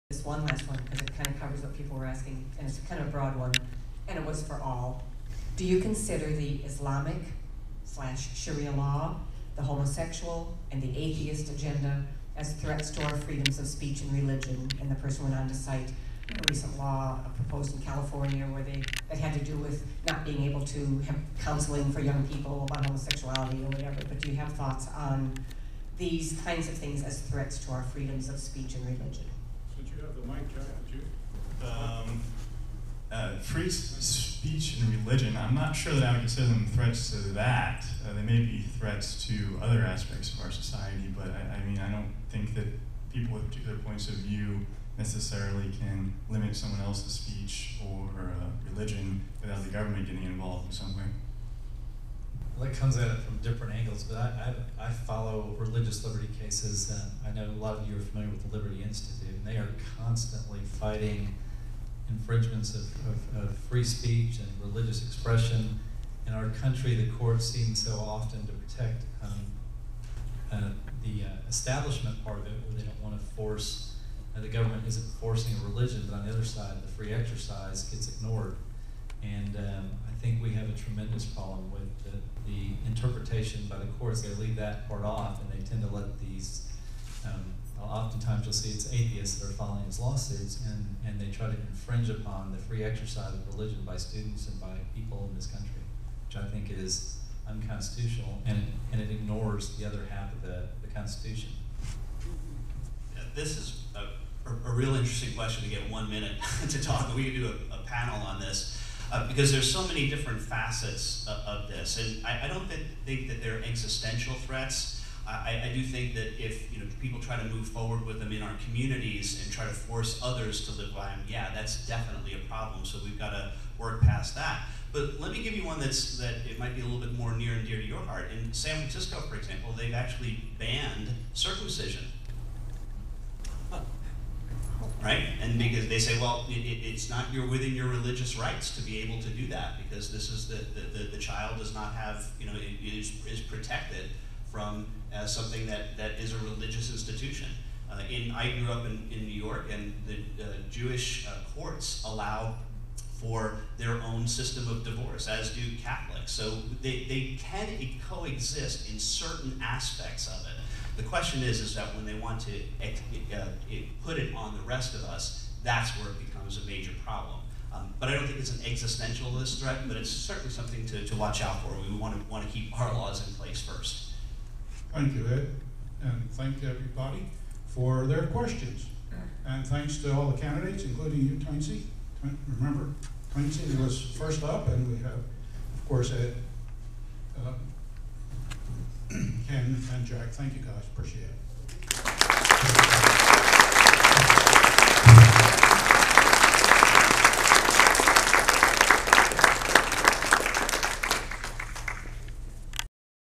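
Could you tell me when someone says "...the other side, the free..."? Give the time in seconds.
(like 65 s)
76 s.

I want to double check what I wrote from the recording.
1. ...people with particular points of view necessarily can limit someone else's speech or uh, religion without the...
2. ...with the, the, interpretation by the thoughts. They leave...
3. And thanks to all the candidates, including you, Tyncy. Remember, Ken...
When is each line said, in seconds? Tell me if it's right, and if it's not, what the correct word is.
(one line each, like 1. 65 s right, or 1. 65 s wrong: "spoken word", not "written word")
1. 43 s right
2. 81 s wrong: "courts", not "thoughts"
3. 179 s wrong: "Tyncy", not "Ken".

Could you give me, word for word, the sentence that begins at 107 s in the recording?
We could do a, a panel on this uh, because there's so many different facets of, of this.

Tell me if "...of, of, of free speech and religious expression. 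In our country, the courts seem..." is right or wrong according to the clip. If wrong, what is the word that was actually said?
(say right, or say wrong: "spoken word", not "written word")
right.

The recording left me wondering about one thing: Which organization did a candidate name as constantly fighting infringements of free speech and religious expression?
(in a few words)
Liberty Institute.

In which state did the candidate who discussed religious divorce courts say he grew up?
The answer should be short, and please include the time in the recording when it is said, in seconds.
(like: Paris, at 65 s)
New York, at 149 s.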